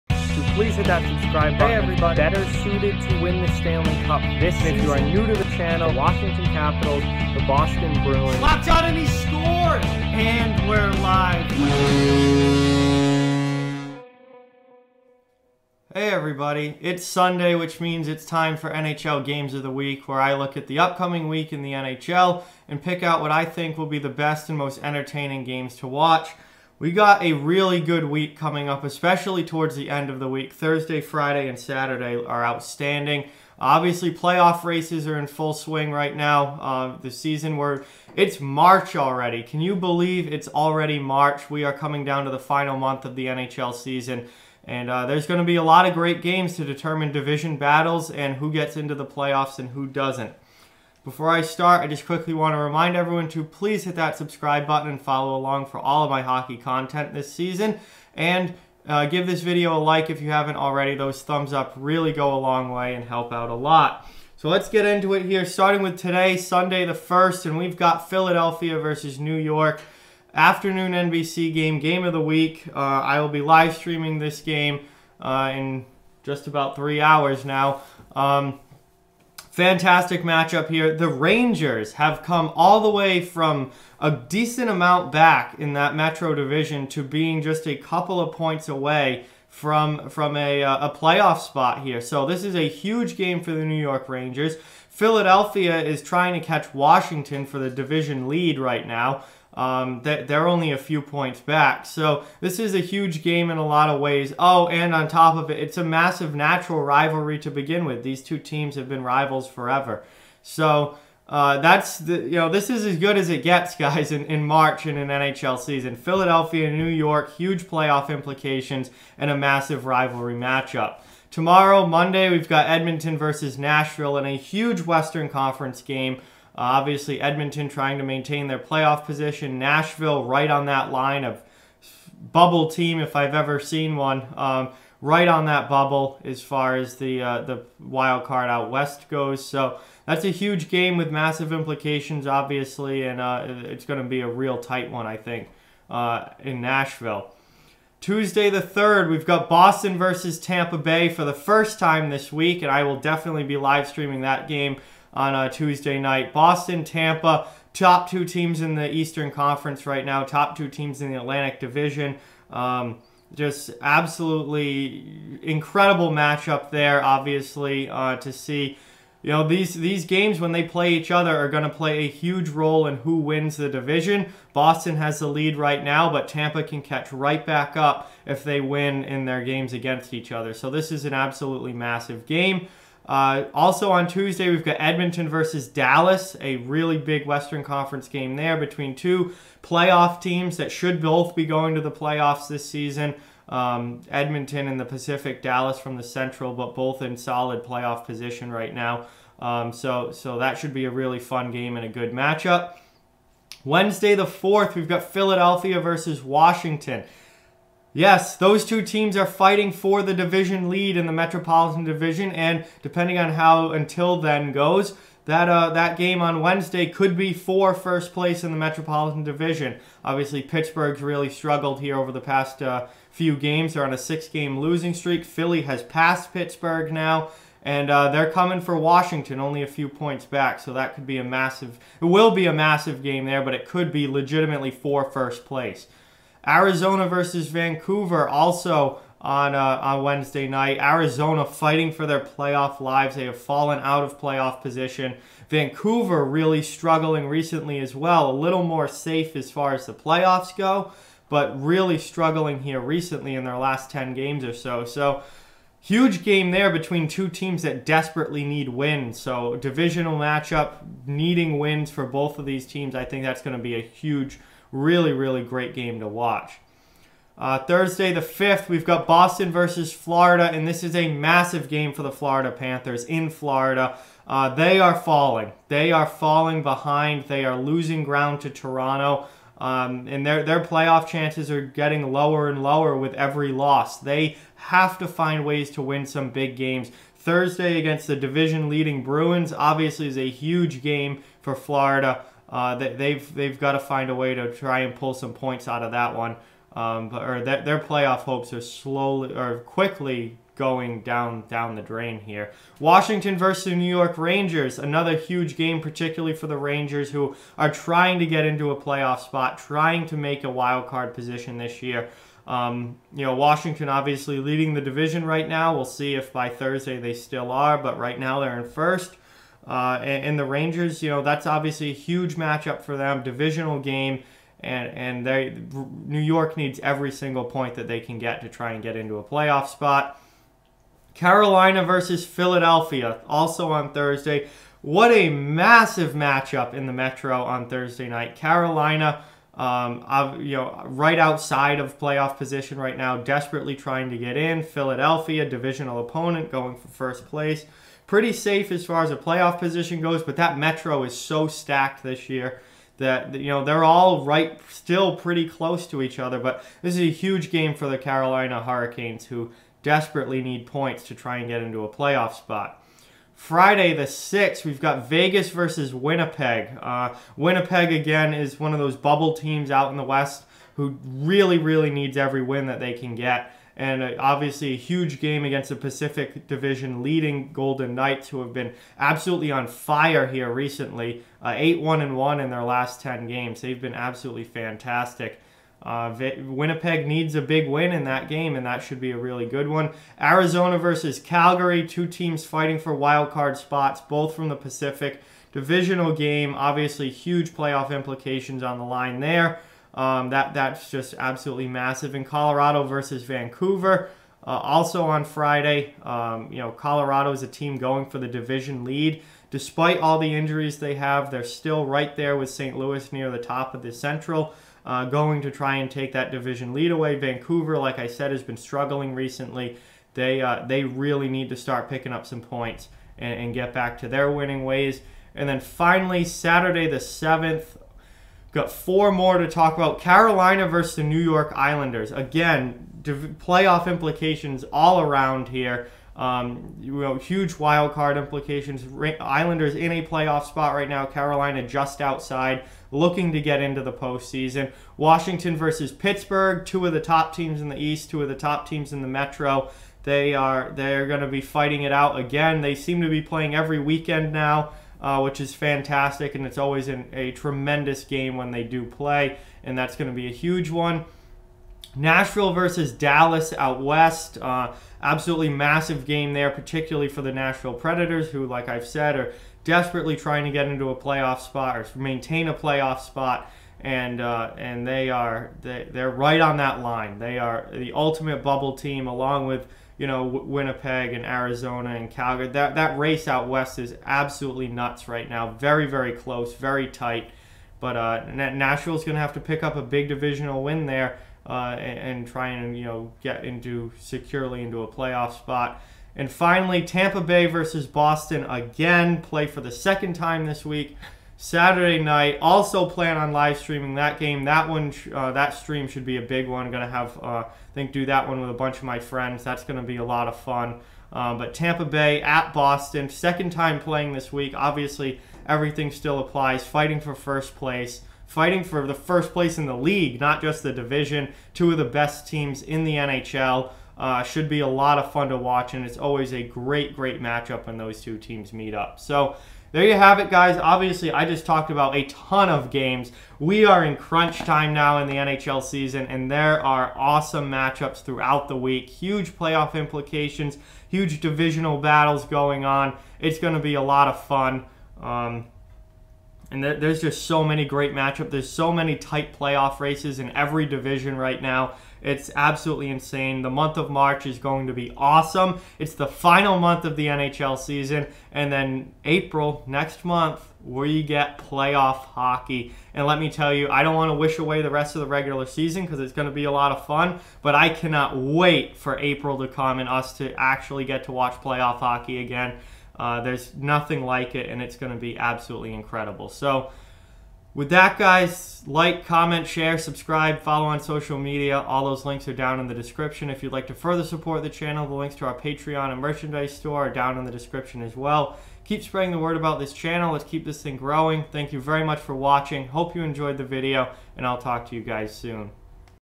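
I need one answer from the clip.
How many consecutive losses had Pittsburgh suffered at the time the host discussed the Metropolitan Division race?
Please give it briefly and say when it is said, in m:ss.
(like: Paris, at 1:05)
6, at 3:43.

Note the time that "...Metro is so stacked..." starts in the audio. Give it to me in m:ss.
5:50.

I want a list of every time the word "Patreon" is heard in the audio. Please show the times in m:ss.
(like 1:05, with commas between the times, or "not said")
9:45.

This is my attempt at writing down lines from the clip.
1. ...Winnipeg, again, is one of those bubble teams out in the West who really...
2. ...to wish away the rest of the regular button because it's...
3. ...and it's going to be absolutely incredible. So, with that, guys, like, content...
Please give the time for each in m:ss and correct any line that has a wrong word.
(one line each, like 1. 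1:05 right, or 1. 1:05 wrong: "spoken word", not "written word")
1. 6:07 right
2. 9:24 wrong: "season", not "button"
3. 9:34 wrong: "comment", not "content".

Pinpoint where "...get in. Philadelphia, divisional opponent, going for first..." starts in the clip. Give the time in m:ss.
5:44.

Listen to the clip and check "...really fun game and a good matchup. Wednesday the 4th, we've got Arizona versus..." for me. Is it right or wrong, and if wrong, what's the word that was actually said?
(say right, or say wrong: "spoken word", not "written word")
wrong: "Philadelphia", not "Arizona".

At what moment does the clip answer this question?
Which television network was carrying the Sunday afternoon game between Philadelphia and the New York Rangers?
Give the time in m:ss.
1:10.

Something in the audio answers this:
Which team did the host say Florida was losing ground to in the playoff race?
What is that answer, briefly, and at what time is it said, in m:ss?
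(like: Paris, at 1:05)
Toronto, at 4:38.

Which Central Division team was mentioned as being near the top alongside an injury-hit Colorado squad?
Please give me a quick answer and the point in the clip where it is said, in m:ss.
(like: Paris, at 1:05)
St. Louis, at 6:52.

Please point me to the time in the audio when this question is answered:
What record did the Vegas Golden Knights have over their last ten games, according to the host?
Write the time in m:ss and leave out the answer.
6:21.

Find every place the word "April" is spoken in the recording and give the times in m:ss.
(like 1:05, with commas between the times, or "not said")
9:19, 9:28.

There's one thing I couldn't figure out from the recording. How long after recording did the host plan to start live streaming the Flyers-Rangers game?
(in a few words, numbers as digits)
About 3 hours.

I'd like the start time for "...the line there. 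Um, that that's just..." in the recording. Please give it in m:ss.
6:38.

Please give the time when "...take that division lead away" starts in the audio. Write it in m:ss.
6:55.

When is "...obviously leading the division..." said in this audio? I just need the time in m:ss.
5:13.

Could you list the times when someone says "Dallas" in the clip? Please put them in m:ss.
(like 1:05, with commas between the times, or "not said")
3:05, 3:15, 7:42.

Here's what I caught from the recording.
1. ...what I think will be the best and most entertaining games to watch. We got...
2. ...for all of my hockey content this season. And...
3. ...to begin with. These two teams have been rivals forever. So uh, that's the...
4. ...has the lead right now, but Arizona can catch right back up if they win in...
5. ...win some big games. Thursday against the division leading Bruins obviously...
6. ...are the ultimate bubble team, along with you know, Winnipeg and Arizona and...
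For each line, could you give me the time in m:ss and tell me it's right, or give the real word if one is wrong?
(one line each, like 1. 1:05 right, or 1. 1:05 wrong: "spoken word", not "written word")
1. 0:23 right
2. 0:55 right
3. 1:47 right
4. 2:54 wrong: "Tampa", not "Arizona"
5. 4:45 right
6. 7:57 right.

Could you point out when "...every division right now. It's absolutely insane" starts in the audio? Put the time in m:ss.
9:10.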